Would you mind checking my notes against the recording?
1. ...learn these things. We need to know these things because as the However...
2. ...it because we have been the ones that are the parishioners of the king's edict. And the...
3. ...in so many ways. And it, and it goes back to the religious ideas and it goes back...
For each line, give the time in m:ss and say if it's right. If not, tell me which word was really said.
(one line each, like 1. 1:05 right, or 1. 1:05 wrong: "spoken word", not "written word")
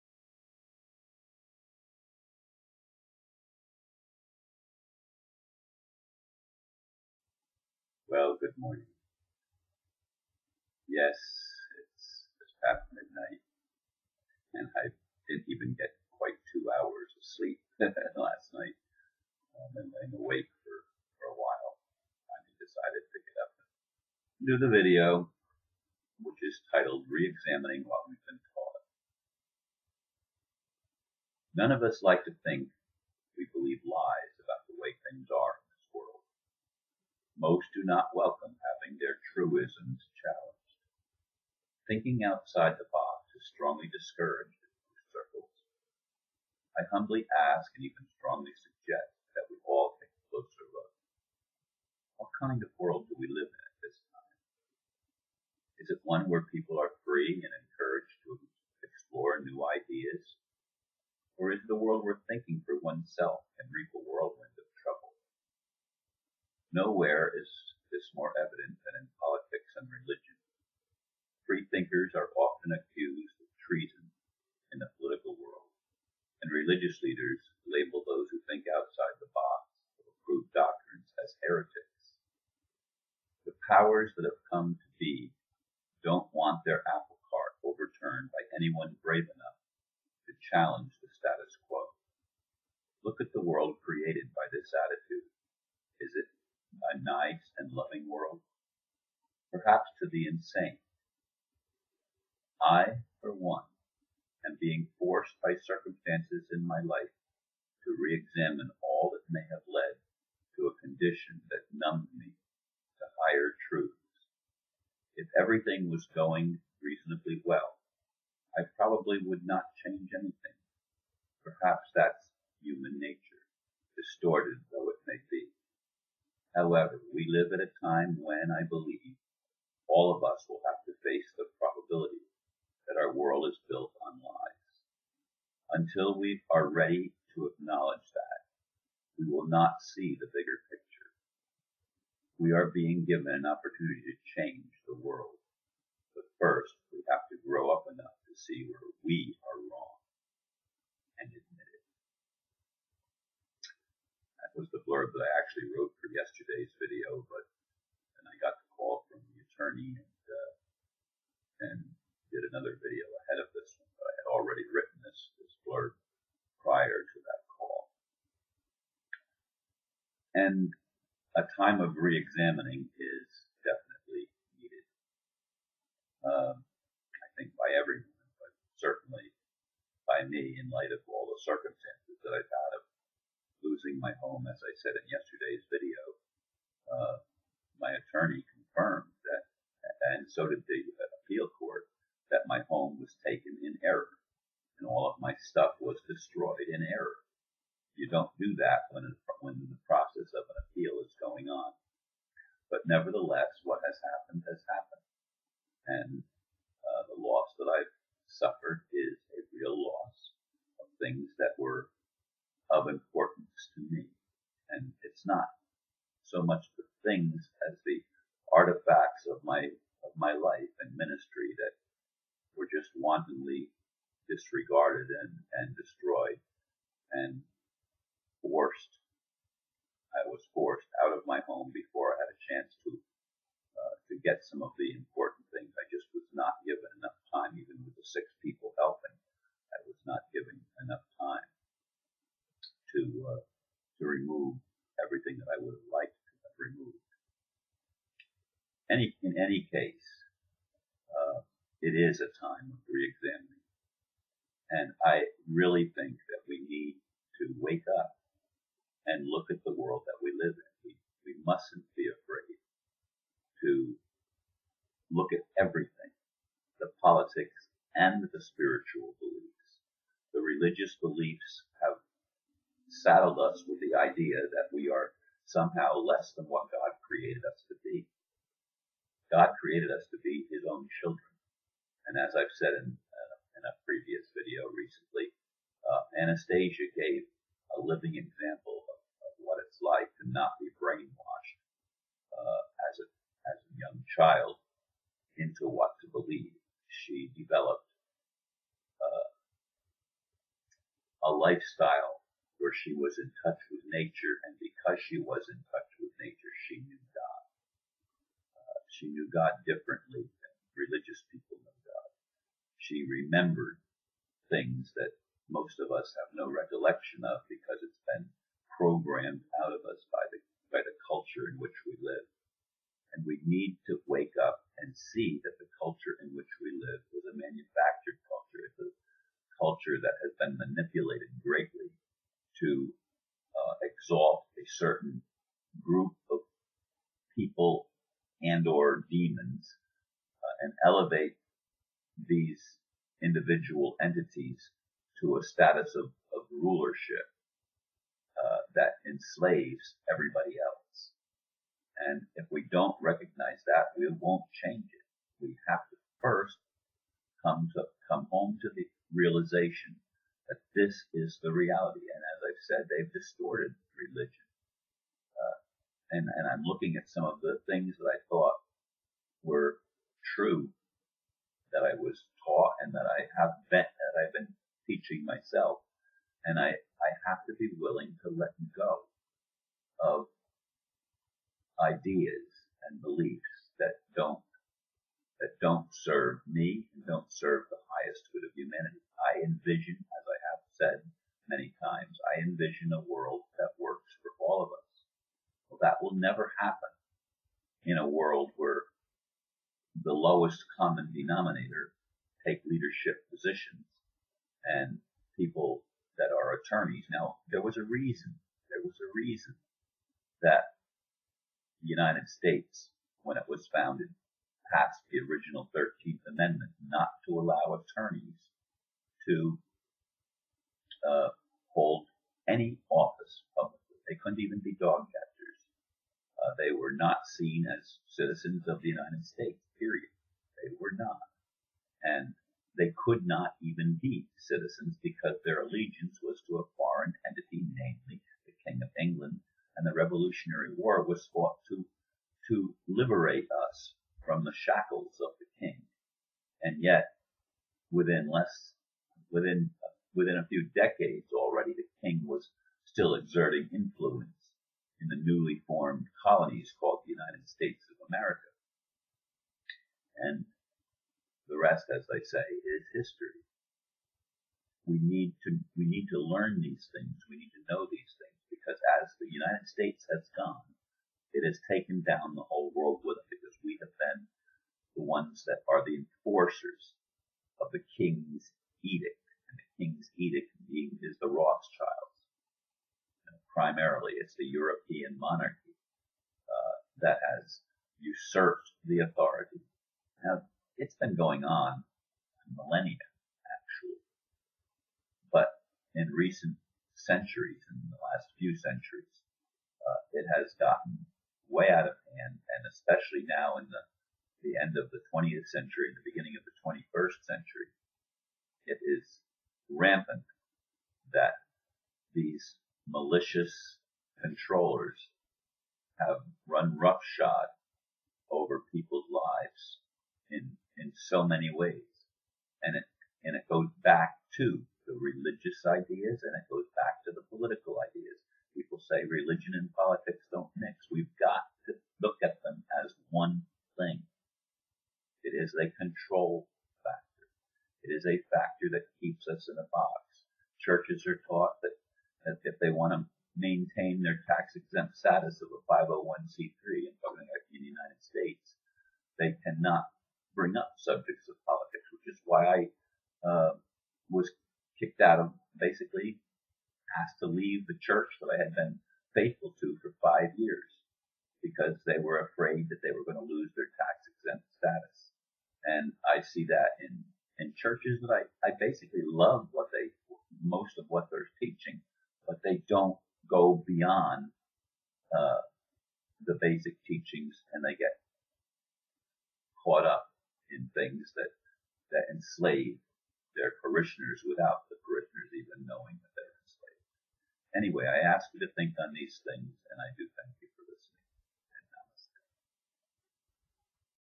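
1. 7:46 wrong: "United", not "However"
2. 7:53 wrong: "enforcers", not "parishioners"
3. 8:40 right.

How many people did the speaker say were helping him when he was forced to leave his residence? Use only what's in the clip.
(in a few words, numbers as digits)
6.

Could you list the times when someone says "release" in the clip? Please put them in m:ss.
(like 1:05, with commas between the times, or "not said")
not said.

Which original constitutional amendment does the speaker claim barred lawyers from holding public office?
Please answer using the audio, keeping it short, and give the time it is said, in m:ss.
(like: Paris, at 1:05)
13th Amendment, at 6:55.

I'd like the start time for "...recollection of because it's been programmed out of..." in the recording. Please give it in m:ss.
5:16.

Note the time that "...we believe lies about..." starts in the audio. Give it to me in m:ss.
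0:33.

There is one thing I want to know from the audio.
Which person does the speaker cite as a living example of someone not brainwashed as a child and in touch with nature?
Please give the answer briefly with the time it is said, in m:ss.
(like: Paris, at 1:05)
Anastasia, at 4:46.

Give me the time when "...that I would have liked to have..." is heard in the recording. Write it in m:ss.
4:05.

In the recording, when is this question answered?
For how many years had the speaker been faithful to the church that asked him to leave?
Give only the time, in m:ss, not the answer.
9:20.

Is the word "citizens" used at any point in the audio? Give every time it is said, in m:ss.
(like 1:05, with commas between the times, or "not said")
7:08, 7:14.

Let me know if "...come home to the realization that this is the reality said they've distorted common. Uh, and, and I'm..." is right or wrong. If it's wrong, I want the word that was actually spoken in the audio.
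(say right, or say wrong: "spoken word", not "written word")
wrong: "religion", not "common".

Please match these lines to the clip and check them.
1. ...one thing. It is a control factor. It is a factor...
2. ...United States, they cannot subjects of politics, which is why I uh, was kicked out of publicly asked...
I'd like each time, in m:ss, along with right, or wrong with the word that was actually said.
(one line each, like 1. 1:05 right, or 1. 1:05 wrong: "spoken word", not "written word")
1. 8:53 right
2. 9:07 wrong: "basically", not "publicly".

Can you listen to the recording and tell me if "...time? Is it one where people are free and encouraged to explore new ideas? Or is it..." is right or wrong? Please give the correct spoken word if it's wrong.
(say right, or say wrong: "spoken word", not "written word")
right.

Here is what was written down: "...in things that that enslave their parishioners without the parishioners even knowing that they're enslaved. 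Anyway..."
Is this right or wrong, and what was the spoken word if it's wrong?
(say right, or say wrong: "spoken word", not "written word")
right.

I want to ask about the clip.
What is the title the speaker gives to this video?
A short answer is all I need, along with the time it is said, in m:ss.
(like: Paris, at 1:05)
Reexamining What We've Been Taught, at 0:27.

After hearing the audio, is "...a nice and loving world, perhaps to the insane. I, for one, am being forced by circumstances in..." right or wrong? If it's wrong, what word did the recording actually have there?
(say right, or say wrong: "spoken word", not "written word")
right.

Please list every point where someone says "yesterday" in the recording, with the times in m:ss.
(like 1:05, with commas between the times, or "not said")
2:36, 3:05.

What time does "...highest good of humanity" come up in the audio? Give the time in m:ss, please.
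6:27.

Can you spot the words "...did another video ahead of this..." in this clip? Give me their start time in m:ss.
2:42.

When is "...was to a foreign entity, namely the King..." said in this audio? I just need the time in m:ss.
7:16.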